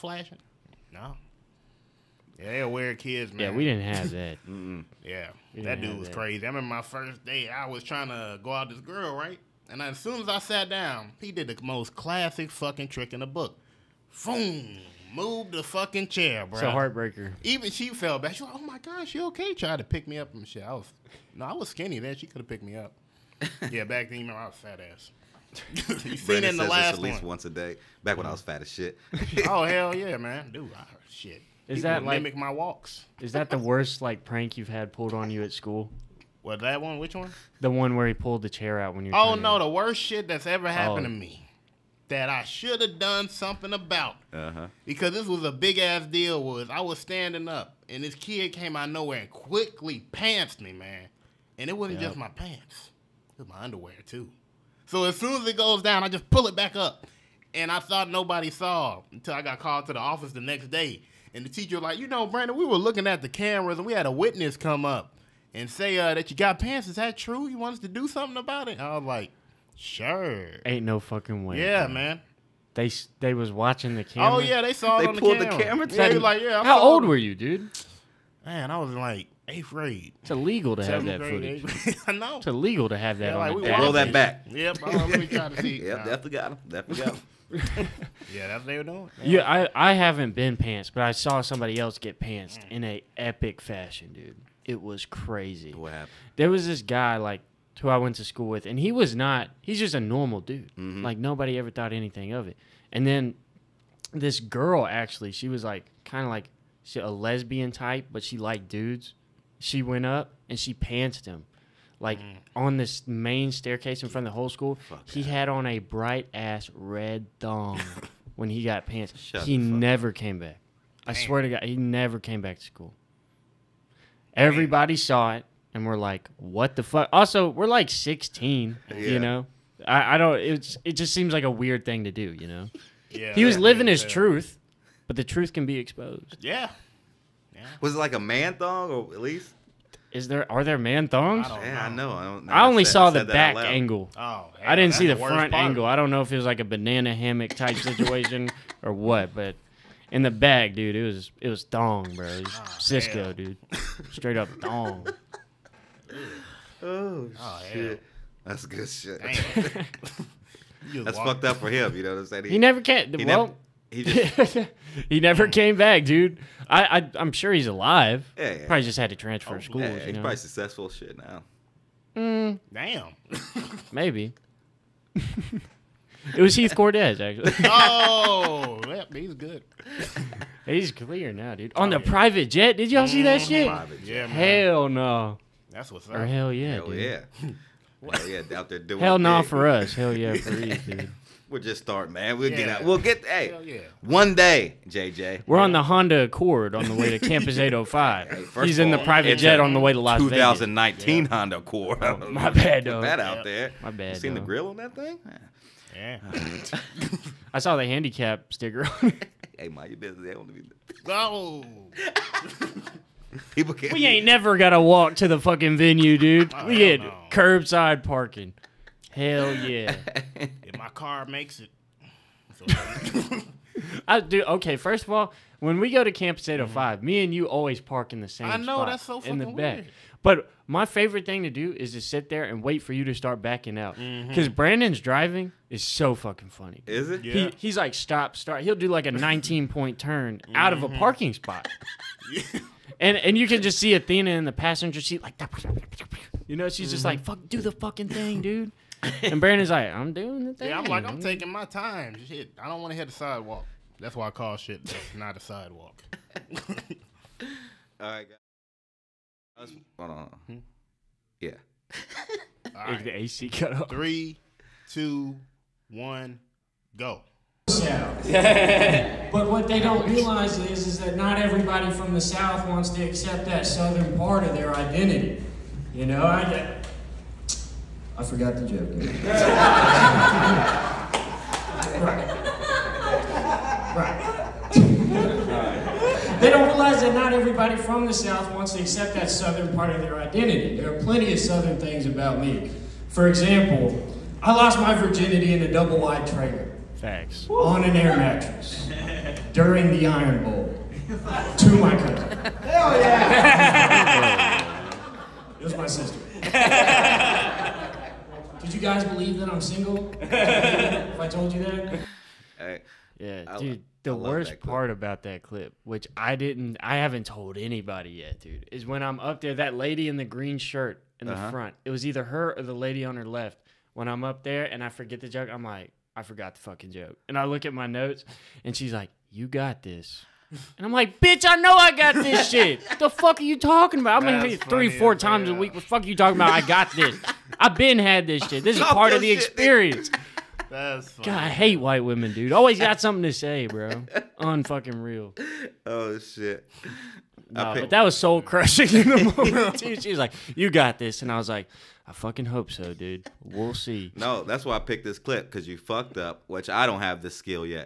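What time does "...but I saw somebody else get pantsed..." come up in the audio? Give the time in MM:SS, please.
01:30.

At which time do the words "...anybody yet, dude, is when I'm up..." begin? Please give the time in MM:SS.
05:17.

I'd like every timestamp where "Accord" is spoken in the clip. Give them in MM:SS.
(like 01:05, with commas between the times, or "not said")
03:16, 03:21.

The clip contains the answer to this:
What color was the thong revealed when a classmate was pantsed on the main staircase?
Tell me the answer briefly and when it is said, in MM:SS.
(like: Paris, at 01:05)
Red, at 01:56.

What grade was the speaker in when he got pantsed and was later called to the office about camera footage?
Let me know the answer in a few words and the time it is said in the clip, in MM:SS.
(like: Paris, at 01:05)
8th grade, at 01:19.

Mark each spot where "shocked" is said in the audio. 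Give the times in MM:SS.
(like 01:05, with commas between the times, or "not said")
not said.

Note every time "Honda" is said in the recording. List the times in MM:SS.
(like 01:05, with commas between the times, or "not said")
03:15, 03:21.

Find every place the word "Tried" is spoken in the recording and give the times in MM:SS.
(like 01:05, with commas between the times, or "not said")
00:19.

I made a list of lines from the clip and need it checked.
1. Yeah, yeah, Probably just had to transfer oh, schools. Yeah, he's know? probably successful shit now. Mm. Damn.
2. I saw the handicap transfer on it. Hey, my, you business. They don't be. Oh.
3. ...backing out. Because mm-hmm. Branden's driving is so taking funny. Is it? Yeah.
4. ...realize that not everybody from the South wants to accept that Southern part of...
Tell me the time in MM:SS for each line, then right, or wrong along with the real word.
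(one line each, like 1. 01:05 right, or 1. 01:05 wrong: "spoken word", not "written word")
1. 02:48 right
2. 03:27 wrong: "sticker", not "transfer"
3. 03:53 wrong: "fucking", not "taking"
4. 04:46 right.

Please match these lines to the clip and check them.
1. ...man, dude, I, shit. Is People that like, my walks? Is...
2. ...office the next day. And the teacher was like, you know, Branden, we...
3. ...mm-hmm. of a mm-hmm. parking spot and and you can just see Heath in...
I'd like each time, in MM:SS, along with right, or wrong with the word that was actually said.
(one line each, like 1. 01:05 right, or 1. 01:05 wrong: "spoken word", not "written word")
1. 00:30 right
2. 00:59 right
3. 04:00 wrong: "Athena", not "Heath".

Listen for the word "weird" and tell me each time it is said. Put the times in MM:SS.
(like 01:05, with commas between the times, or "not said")
00:02, 02:11, 03:49.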